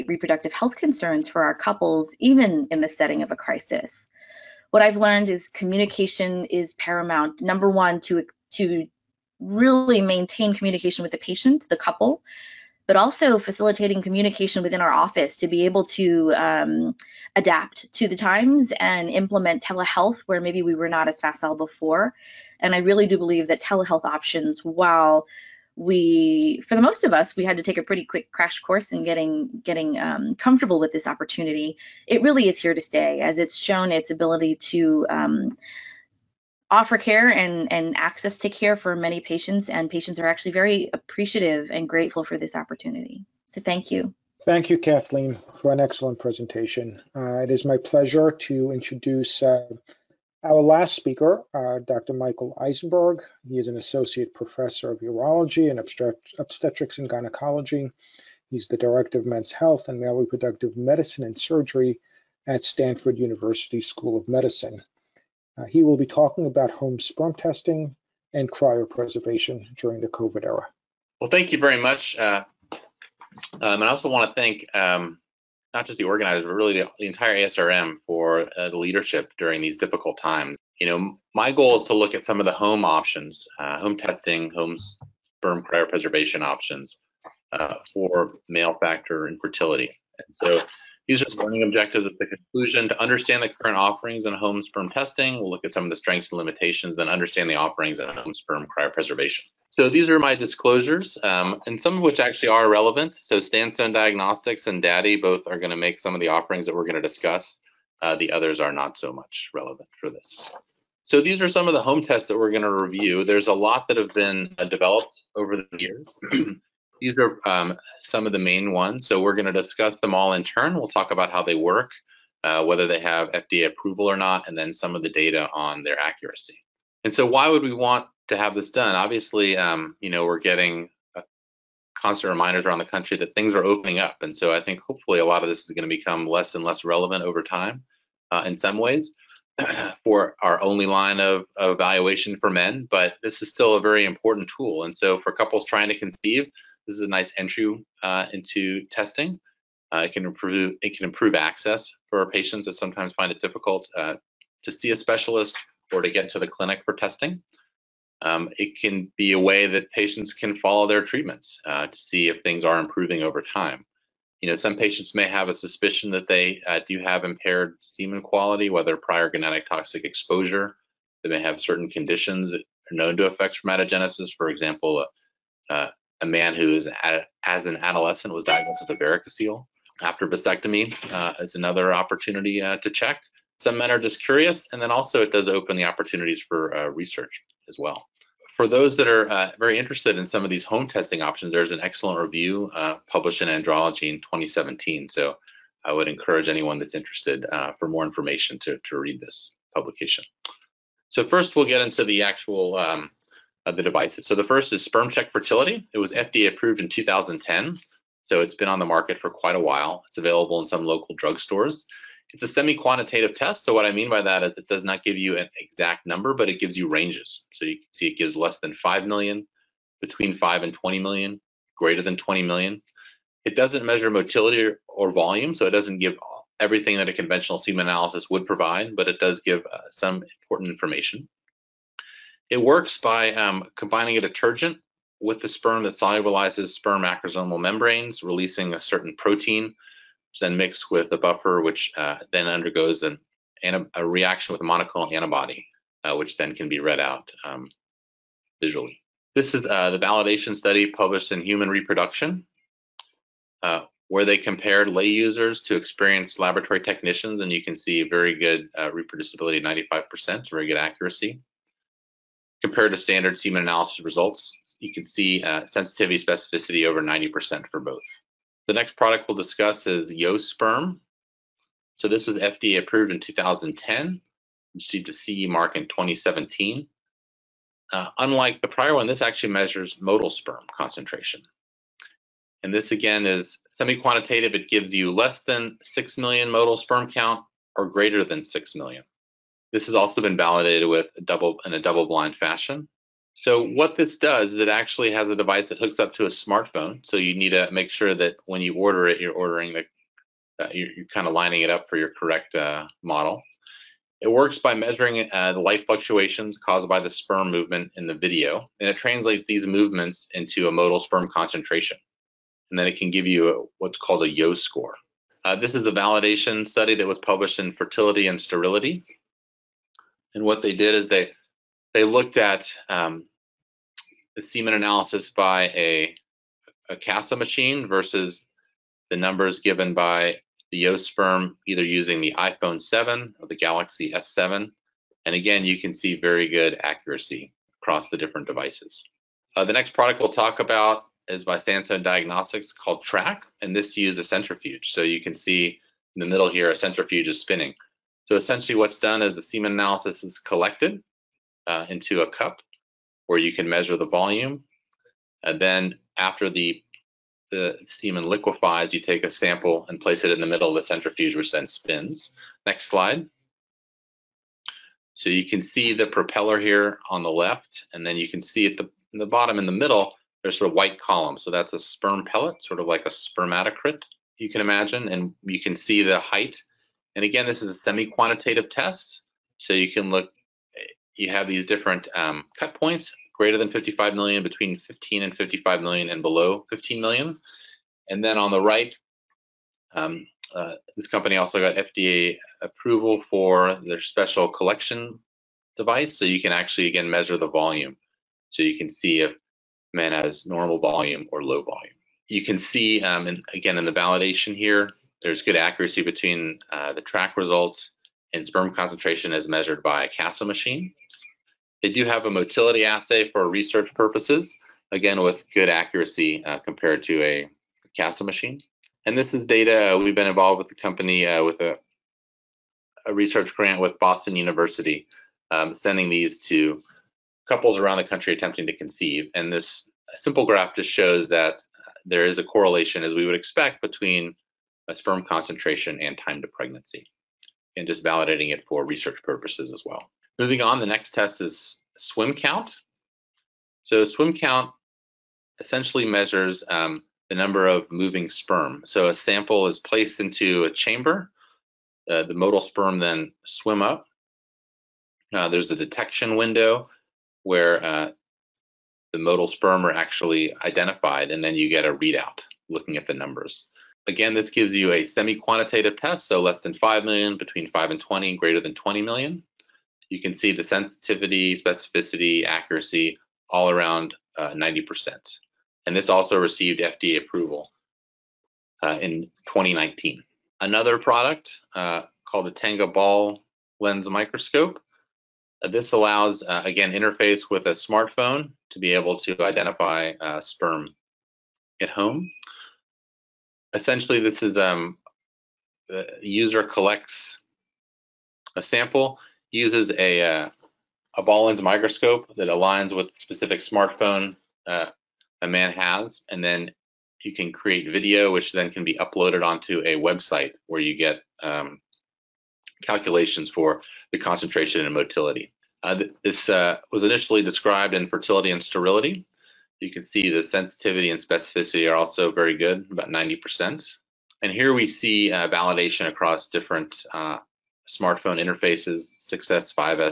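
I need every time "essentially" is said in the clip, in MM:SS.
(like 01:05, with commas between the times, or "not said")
05:48, 07:25, 08:13.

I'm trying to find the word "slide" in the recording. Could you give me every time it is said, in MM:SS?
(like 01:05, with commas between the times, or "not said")
06:02.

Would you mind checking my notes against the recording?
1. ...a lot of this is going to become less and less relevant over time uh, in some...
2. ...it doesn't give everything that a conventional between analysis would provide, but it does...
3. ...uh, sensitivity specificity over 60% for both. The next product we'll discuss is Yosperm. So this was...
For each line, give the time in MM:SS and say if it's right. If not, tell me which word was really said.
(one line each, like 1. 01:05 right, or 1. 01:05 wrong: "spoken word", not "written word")
1. 02:15 right
2. 03:45 wrong: "semen", not "between"
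3. 04:25 wrong: "90", not "60".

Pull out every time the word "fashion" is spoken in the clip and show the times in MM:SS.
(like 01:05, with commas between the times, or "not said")
04:52.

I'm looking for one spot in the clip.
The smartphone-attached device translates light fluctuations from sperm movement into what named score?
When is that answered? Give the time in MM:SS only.
05:14.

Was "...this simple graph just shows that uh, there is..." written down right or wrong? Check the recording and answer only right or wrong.
right.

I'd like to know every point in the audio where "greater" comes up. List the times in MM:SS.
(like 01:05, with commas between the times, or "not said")
03:41, 04:47, 06:23, 07:48.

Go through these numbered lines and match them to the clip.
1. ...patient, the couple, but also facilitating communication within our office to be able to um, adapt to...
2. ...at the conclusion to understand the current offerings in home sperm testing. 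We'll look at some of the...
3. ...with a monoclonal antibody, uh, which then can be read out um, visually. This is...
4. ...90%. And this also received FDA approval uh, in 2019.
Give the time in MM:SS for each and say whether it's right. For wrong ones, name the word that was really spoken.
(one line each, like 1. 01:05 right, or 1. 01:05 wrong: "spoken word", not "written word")
1. 00:11 right
2. 01:32 right
3. 04:04 right
4. 07:54 right.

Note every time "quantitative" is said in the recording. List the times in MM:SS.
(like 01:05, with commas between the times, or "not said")
03:32, 04:43, 06:17, 07:45.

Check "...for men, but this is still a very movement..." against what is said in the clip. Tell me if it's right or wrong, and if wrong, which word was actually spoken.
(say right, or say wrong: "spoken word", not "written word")
wrong: "important", not "movement".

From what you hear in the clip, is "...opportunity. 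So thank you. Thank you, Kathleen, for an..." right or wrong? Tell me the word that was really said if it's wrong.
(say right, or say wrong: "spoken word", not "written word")
right.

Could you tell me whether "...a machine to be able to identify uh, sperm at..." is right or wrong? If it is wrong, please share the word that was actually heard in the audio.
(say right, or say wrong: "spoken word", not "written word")
wrong: "smartphone", not "machine".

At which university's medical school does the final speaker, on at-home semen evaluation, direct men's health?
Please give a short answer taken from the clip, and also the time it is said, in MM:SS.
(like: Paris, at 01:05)
Stanford University, at 01:02.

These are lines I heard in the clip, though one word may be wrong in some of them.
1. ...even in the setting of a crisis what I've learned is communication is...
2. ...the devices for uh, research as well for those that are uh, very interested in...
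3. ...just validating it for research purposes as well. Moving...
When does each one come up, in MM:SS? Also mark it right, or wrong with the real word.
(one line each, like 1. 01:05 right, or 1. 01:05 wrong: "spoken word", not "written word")
1. 00:02 right
2. 03:05 wrong: "opportunities", not "devices"
3. 07:17 right.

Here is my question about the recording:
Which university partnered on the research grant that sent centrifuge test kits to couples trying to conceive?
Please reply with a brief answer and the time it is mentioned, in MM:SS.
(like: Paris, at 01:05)
Boston University, at 07:03.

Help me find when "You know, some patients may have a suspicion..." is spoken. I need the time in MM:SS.
02:44.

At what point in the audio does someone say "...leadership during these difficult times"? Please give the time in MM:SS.
01:18.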